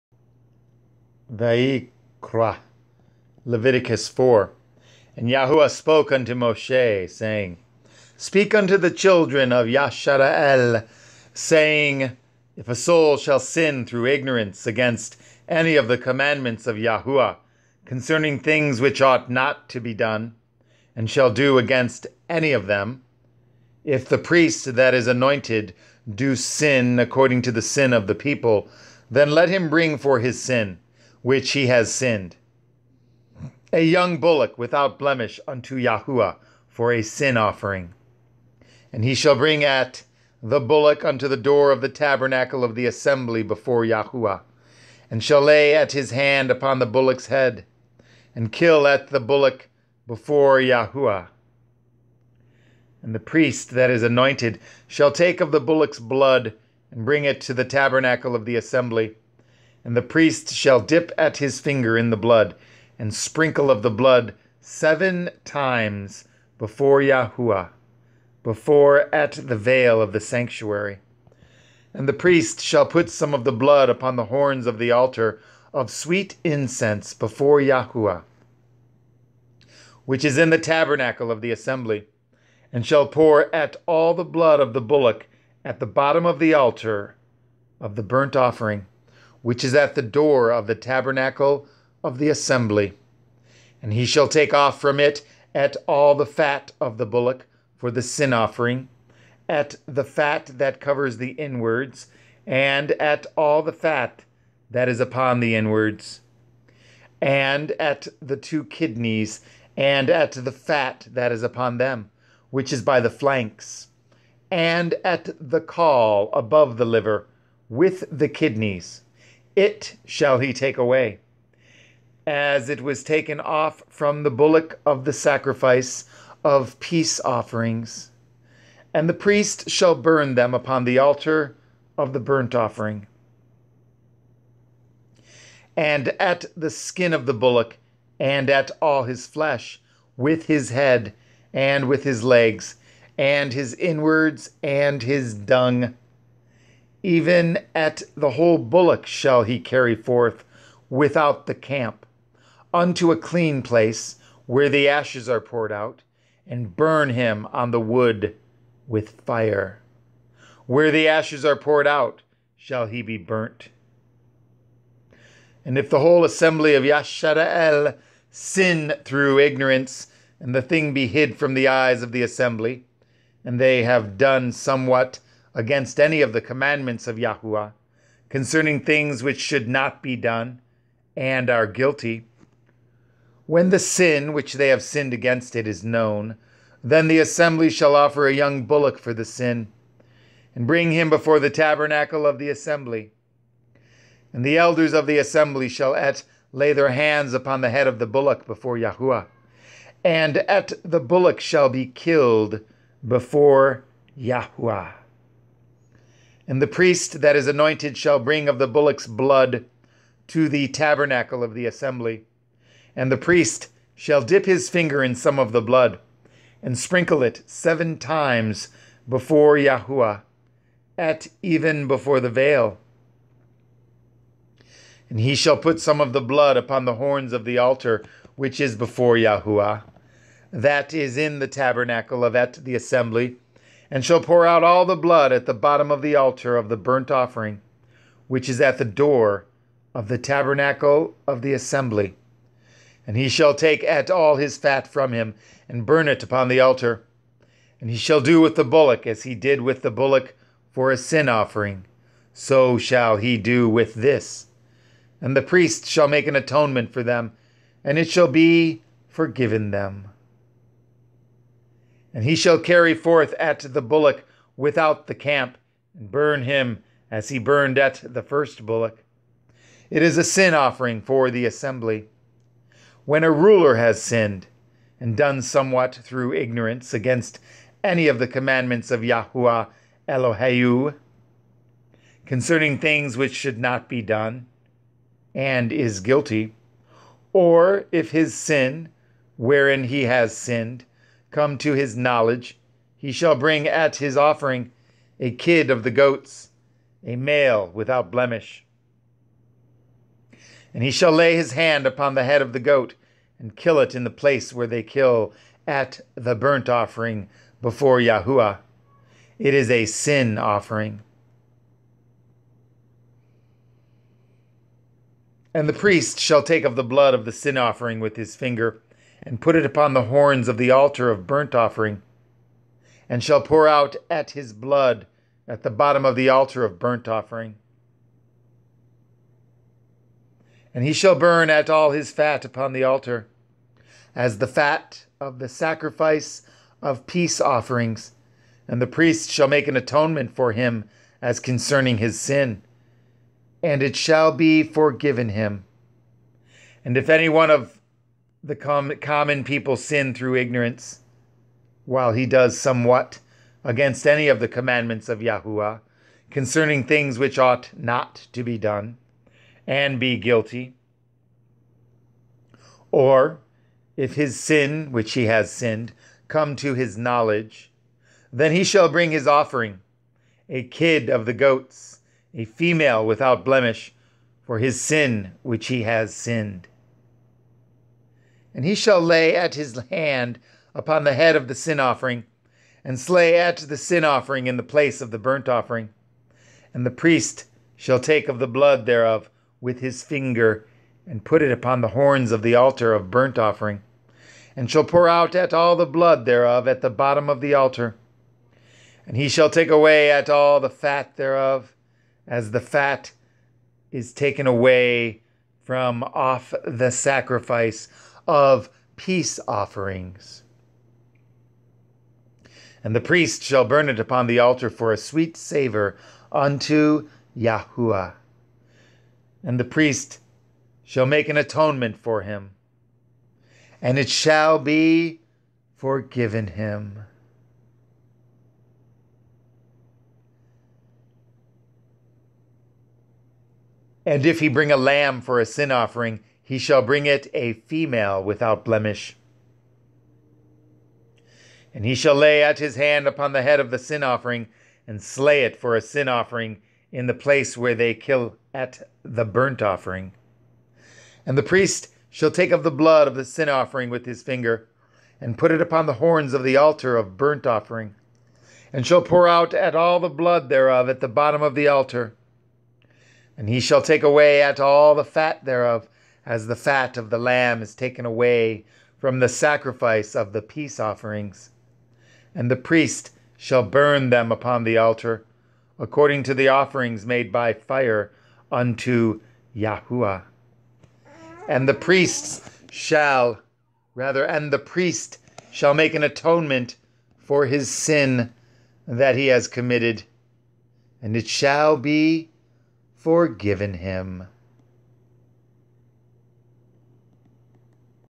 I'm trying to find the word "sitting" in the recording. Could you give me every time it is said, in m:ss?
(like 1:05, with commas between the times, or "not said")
not said.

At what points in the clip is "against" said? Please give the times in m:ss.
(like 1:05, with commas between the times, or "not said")
0:14, 0:21, 2:55, 3:05, 4:36, 5:53.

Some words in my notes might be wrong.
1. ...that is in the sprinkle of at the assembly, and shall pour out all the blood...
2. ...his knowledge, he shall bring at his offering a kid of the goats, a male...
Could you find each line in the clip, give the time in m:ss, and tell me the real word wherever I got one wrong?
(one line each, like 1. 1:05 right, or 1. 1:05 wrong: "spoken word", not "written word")
1. 3:50 wrong: "tabernacle", not "sprinkle"
2. 4:51 right.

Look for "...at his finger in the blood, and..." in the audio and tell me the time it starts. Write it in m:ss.
1:01.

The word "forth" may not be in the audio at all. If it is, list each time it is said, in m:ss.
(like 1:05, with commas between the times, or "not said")
2:29, 4:22.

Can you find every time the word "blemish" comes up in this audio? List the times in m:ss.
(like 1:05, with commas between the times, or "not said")
0:34, 4:58, 6:13, 7:18.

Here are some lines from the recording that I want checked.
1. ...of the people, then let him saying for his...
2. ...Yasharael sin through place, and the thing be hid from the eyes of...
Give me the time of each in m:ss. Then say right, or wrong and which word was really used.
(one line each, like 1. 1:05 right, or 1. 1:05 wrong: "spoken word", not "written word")
1. 0:27 wrong: "bring", not "saying"
2. 2:46 wrong: "ignorance", not "place".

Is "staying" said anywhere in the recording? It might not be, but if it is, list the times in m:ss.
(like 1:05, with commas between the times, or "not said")
not said.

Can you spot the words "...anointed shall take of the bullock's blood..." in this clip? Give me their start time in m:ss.
0:54.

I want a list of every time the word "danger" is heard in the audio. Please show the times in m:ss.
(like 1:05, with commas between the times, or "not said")
not said.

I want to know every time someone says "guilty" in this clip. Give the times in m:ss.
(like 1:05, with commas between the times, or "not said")
3:01, 4:46, 6:00.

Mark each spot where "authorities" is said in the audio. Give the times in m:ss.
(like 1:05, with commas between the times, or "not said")
not said.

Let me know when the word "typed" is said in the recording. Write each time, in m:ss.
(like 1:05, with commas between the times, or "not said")
not said.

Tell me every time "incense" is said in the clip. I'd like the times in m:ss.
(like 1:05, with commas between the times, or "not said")
1:16.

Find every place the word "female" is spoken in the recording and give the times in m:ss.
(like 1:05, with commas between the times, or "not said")
6:12, 7:17.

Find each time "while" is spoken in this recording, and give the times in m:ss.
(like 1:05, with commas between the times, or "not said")
5:51.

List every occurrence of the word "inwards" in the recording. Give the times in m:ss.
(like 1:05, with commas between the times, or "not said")
1:41, 1:45, 2:23.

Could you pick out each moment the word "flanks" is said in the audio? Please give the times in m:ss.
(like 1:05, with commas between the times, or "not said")
1:53.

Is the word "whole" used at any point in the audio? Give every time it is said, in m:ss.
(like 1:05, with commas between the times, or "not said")
2:28, 2:45.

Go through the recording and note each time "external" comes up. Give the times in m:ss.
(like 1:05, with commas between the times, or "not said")
not said.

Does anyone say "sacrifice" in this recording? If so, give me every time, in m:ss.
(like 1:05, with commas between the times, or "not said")
2:05, 5:35, 6:46, 7:49.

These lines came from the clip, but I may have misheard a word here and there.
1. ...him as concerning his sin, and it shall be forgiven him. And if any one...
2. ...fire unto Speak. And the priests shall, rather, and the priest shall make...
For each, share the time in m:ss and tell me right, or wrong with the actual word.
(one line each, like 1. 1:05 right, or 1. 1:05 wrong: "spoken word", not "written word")
1. 5:40 right
2. 7:57 wrong: "Yahuwah", not "Speak".